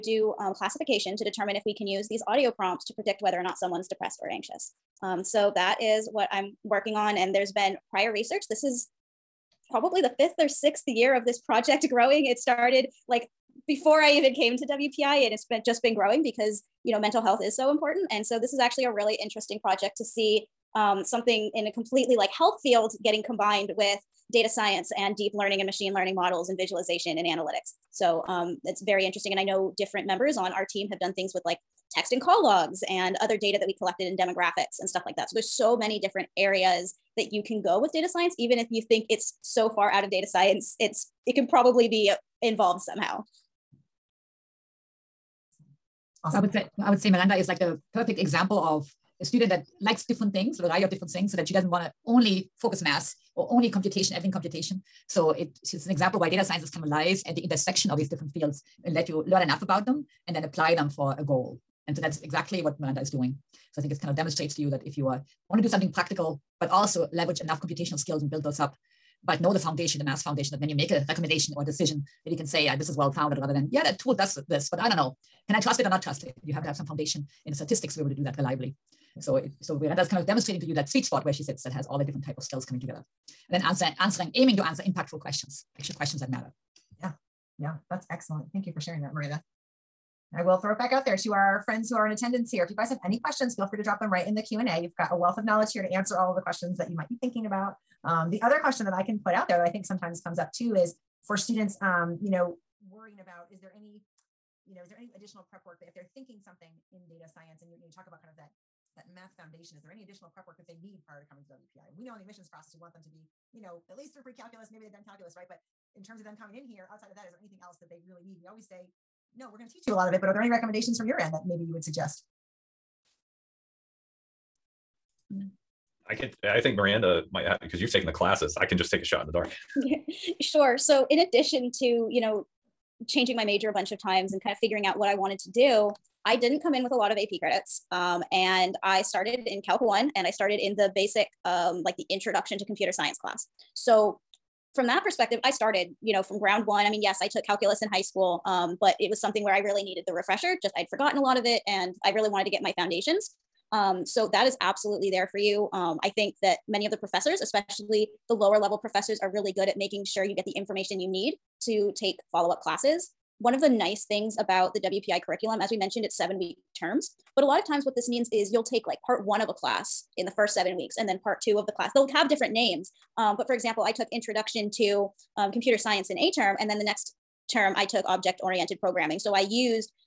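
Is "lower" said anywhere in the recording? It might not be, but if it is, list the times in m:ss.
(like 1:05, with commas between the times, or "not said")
2:38.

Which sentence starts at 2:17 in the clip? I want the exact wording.
Um, and I started in Calc 1 and I started in the basic, um, like the introduction to computer science class.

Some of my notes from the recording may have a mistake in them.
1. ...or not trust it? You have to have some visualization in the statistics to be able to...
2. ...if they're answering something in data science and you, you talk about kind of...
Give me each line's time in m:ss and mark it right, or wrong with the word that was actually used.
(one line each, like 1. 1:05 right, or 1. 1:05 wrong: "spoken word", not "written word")
1. 1:15 wrong: "foundation", not "visualization"
2. 1:45 wrong: "thinking", not "answering".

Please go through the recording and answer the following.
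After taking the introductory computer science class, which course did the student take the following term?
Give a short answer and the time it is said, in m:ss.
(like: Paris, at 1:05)
object oriented programming, at 2:58.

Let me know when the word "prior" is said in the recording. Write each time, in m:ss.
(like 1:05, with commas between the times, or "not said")
0:07, 1:51.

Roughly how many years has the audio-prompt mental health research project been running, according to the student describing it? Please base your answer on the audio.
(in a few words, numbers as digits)
5 or 6.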